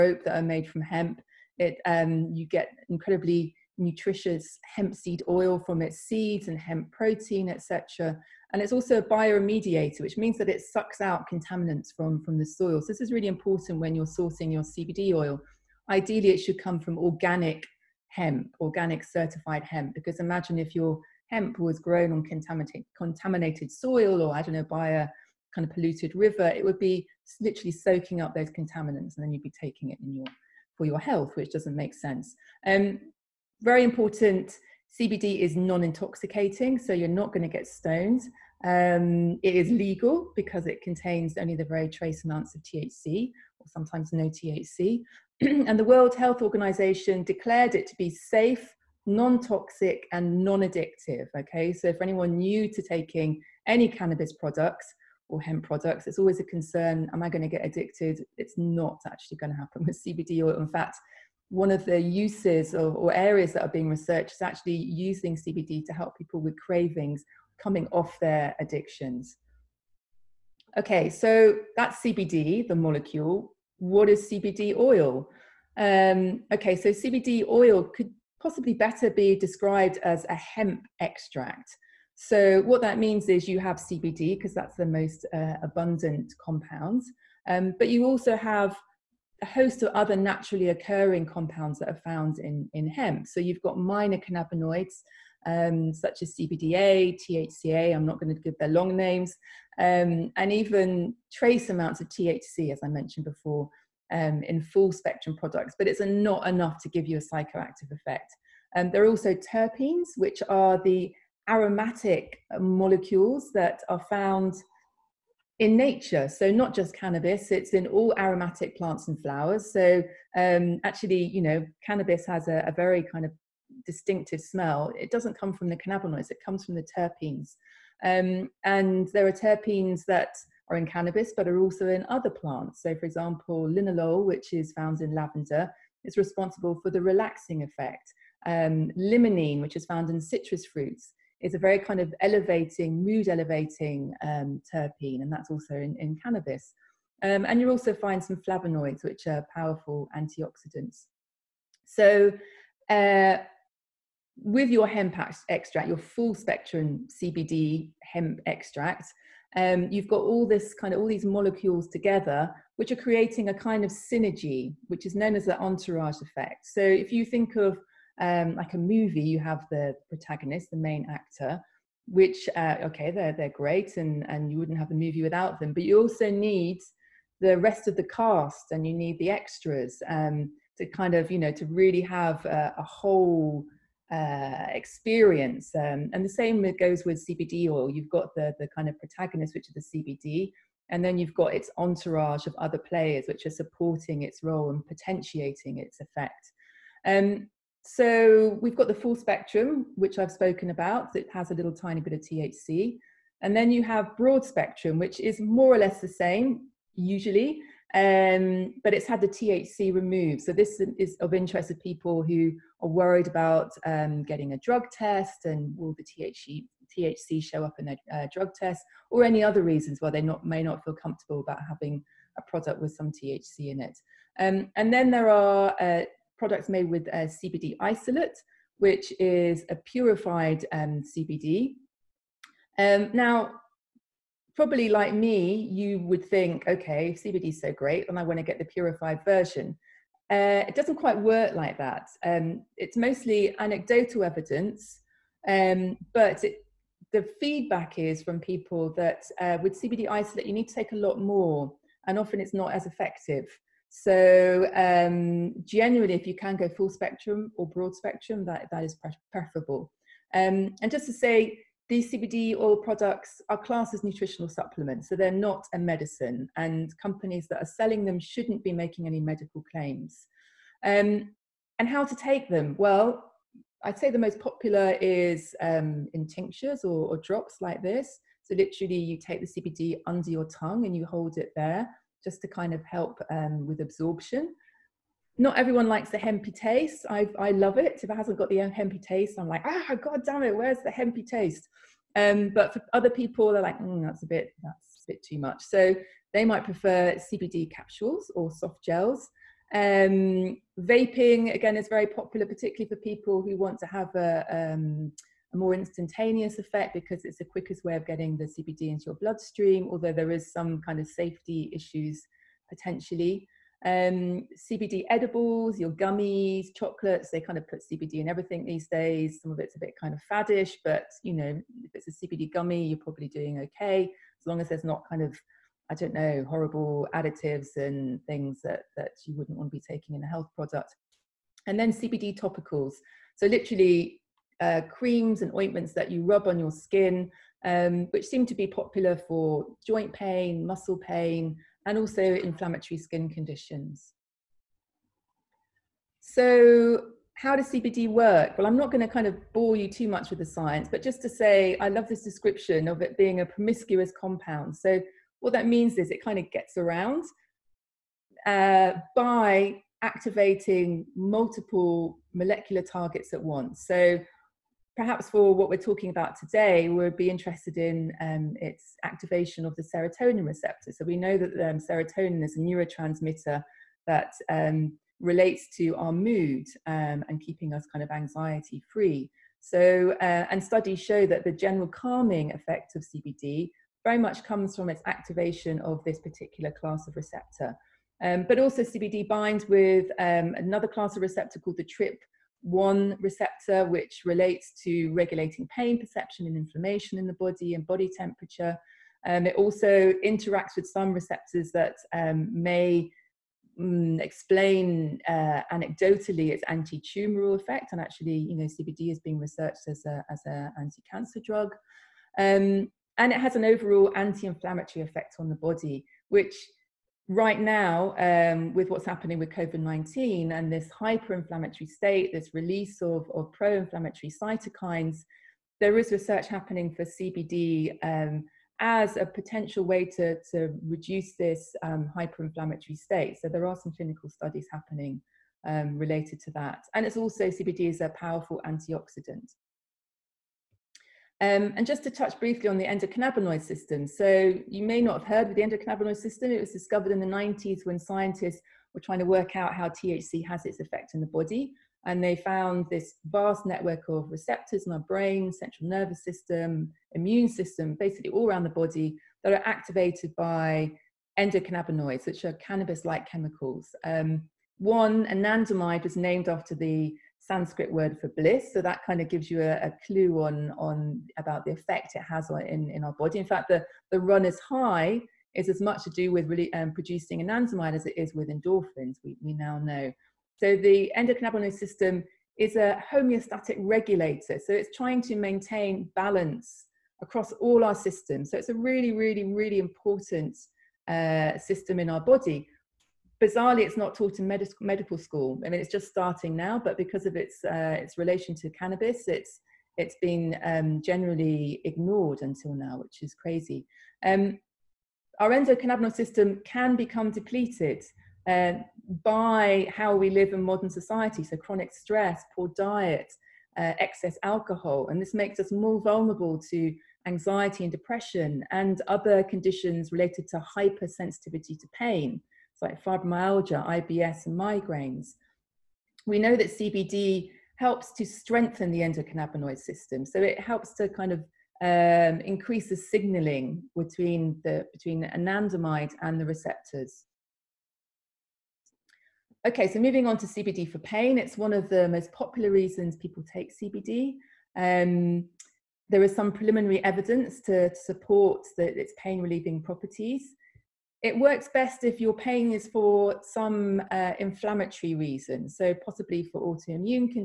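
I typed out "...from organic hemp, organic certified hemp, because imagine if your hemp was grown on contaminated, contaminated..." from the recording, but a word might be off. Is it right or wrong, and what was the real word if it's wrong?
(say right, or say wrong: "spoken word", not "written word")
right.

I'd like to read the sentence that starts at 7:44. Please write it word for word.
Um, one, anandamide was named after the Sanskrit word for bliss.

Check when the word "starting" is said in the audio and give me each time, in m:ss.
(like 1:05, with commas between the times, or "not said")
8:16.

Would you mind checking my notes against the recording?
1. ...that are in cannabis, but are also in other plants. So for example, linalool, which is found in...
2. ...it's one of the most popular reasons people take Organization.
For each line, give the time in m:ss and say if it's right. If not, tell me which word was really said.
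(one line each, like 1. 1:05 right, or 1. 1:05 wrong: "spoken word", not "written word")
1. 2:10 right
2. 9:01 wrong: "CBD", not "Organization".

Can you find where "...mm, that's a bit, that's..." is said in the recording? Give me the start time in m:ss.
4:53.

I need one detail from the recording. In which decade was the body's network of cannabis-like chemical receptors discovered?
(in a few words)
the 90s.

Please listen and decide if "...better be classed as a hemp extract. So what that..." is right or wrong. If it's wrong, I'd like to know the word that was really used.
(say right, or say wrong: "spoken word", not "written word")
wrong: "described", not "classed".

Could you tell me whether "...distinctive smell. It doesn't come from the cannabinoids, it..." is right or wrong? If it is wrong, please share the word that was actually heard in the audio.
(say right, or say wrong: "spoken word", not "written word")
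right.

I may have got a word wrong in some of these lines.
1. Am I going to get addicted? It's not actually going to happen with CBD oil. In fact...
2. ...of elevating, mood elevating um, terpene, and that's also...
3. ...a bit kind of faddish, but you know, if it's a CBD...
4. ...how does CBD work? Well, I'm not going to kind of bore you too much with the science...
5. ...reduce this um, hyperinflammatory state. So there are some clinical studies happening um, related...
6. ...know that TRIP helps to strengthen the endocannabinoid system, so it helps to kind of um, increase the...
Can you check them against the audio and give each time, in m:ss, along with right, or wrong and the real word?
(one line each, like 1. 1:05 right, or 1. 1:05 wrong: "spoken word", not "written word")
1. 0:57 right
2. 2:21 right
3. 5:19 right
4. 5:47 right
5. 7:10 right
6. 8:46 wrong: "CBD", not "TRIP".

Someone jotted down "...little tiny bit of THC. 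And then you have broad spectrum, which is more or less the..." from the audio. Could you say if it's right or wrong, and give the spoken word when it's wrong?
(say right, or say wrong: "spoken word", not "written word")
right.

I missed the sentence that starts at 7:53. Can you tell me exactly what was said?
In fact, the the run is high is as much to do with really um, producing anandamide as it is with endorphins.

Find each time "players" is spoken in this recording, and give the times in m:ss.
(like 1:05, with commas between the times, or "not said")
3:12.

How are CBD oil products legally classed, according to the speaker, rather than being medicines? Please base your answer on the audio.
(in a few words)
nutritional supplements.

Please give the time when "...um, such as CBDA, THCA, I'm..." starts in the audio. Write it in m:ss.
1:35.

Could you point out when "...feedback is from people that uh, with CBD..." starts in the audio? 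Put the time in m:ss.
4:07.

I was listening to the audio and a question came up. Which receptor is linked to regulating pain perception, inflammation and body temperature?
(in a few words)
TRIP one receptor.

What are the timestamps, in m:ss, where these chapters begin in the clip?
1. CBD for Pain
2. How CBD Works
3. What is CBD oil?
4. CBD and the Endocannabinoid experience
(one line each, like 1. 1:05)
1. 8:57
2. 5:44
3. 1:09
4. 7:20.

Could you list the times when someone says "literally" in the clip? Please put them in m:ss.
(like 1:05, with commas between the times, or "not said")
0:27, 4:38, 5:33.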